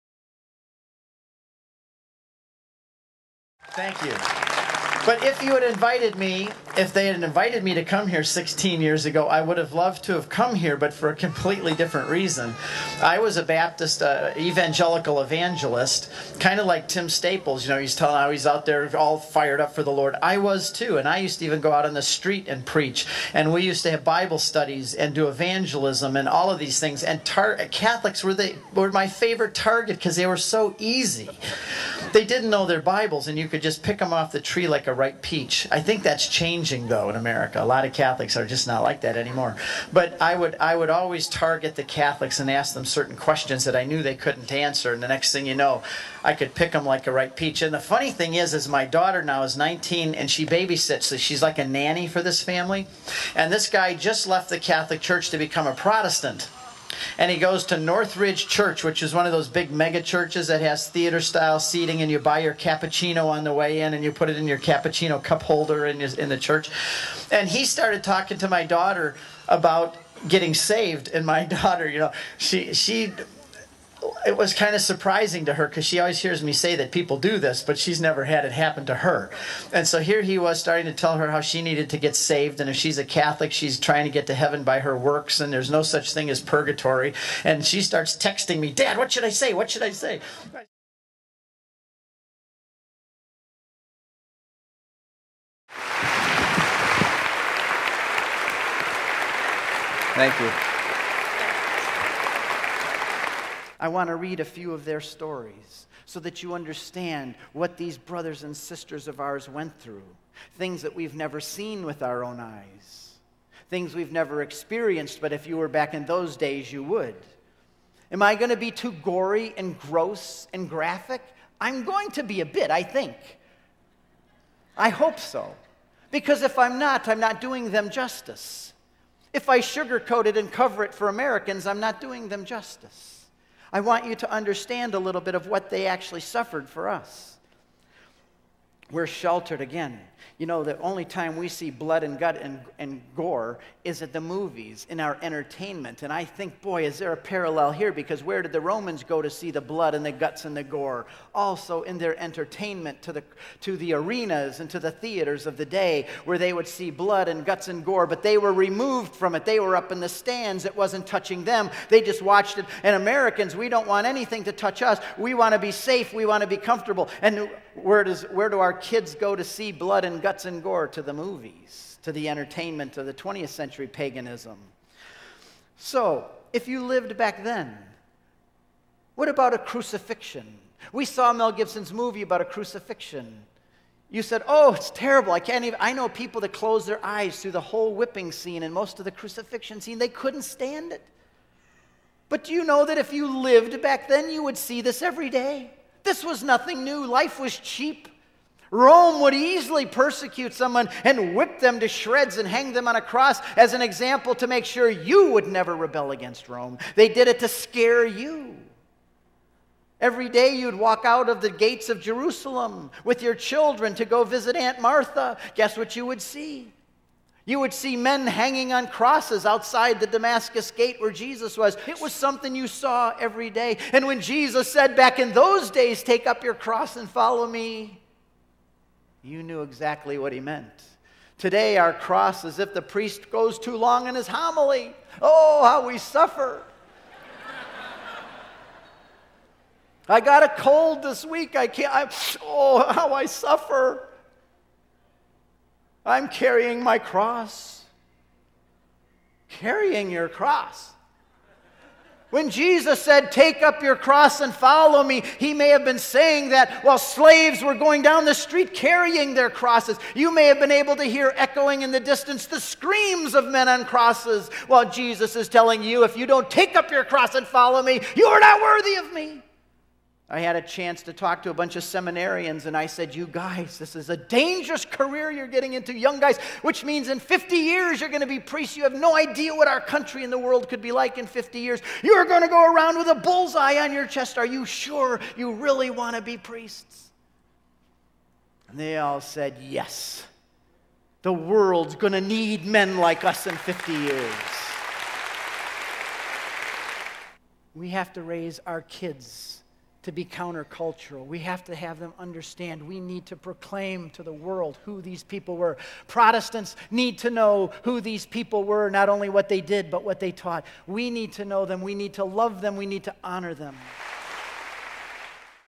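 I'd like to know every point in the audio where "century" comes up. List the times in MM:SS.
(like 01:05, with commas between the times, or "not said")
02:53.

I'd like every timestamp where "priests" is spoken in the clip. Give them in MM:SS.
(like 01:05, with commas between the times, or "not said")
03:52, 04:38, 04:46.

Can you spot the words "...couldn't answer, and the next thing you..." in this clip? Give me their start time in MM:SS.
00:44.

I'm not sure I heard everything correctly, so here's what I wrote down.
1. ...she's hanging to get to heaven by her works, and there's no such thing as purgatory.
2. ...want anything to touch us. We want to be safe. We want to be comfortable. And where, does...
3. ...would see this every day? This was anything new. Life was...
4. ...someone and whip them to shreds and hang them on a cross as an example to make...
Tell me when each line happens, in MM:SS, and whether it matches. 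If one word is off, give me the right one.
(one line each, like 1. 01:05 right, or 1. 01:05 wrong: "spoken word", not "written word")
1. 01:23 wrong: "trying", not "hanging"
2. 02:43 right
3. 03:14 wrong: "nothing", not "anything"
4. 03:20 right.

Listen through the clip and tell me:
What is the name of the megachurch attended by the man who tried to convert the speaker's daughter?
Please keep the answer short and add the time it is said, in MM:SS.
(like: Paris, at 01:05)
Northridge Church, at 00:57.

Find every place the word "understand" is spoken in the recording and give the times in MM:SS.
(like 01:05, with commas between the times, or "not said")
01:46, 02:14, 05:02.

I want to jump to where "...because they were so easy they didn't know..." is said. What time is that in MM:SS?
00:29.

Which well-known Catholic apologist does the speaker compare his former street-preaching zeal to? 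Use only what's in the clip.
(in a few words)
Tim Staples.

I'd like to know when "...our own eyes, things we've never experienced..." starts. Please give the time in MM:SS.
01:52.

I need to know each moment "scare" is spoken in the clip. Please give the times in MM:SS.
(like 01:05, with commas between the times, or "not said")
03:27.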